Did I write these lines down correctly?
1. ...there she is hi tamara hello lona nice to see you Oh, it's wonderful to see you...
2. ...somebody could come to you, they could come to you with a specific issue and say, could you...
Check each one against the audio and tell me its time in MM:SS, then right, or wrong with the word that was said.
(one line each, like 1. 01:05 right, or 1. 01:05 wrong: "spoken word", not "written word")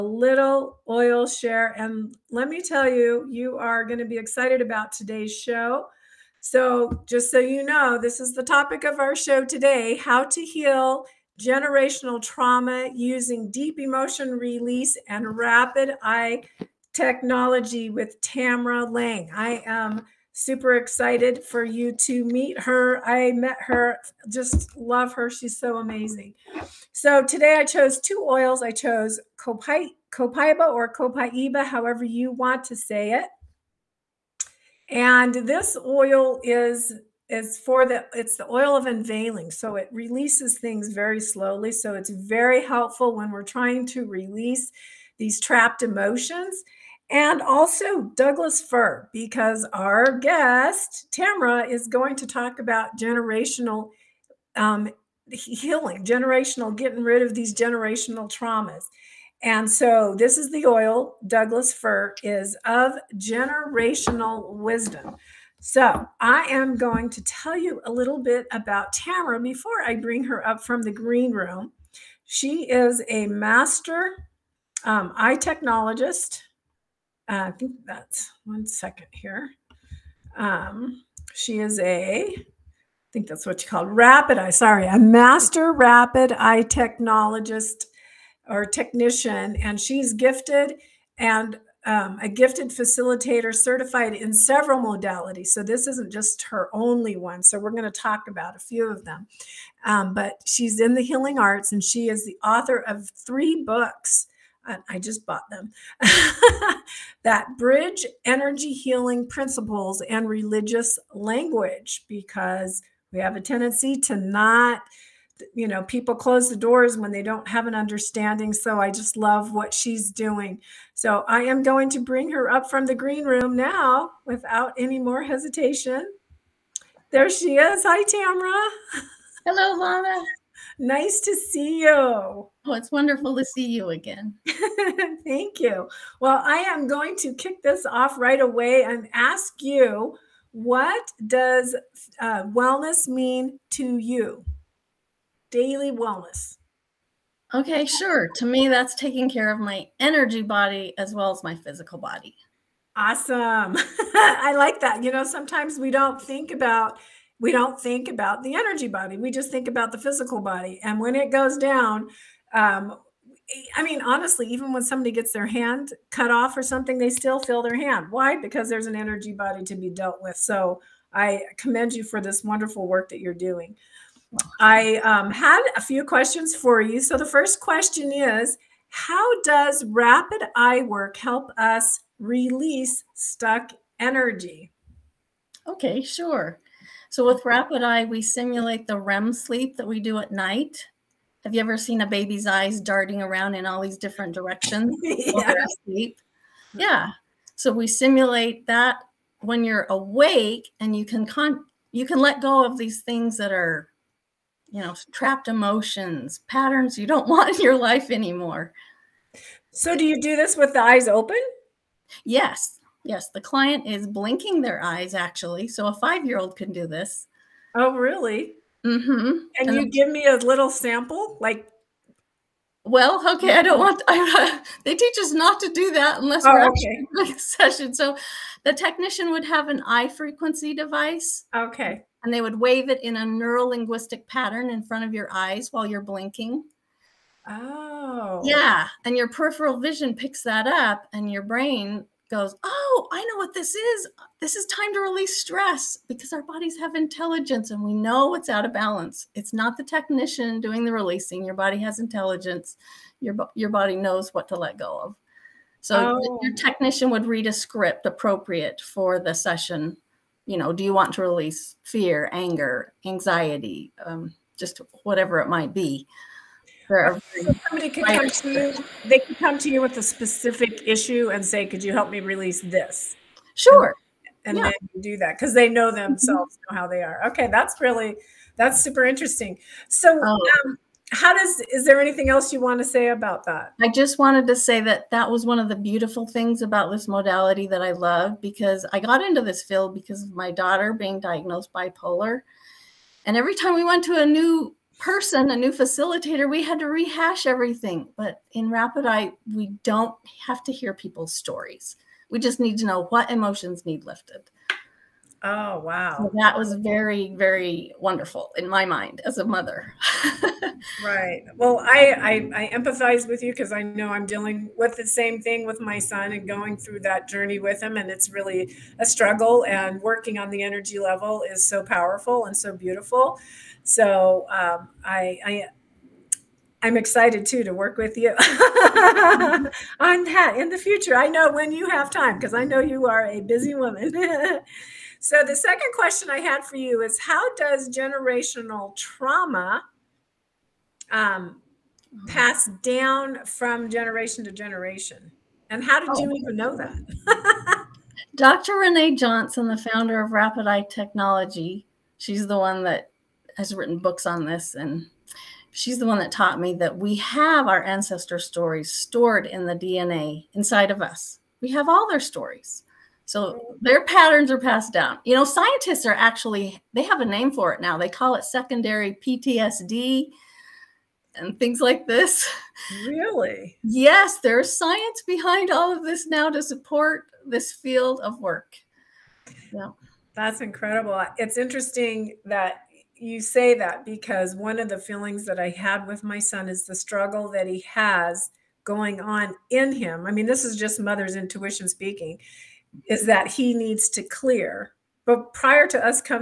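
1. 02:07 right
2. 04:27 right.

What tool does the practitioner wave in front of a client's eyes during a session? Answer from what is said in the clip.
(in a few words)
Eye frequency device.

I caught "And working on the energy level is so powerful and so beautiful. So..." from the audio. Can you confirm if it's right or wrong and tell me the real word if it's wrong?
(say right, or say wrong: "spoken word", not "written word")
right.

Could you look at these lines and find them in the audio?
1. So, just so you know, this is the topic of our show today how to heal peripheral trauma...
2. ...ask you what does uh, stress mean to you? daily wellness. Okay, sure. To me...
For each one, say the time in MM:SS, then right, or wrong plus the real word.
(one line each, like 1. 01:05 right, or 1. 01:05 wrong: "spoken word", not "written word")
1. 00:06 wrong: "generational", not "peripheral"
2. 02:19 wrong: "wellness", not "stress".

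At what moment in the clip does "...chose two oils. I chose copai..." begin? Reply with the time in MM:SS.
00:27.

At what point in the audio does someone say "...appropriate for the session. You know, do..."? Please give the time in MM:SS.
04:18.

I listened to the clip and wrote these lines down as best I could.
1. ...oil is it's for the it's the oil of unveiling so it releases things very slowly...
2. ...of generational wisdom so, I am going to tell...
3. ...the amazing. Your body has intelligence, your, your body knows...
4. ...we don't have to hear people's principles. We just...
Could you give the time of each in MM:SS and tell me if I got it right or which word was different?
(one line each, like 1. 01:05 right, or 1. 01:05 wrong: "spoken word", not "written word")
1. 00:35 right
2. 01:02 right
3. 04:10 wrong: "releasing", not "amazing"
4. 04:59 wrong: "stories", not "principles".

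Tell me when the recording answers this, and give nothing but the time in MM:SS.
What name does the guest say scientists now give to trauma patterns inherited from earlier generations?
06:08.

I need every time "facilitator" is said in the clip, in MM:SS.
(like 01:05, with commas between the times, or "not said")
01:32, 04:55.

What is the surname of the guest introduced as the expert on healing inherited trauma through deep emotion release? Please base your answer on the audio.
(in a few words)
Laing.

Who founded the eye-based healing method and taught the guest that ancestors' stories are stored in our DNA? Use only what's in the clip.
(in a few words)
Dr. Ranae Johnson.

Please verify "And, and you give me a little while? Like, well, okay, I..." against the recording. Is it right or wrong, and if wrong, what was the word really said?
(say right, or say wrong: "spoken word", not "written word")
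wrong: "sample", not "while".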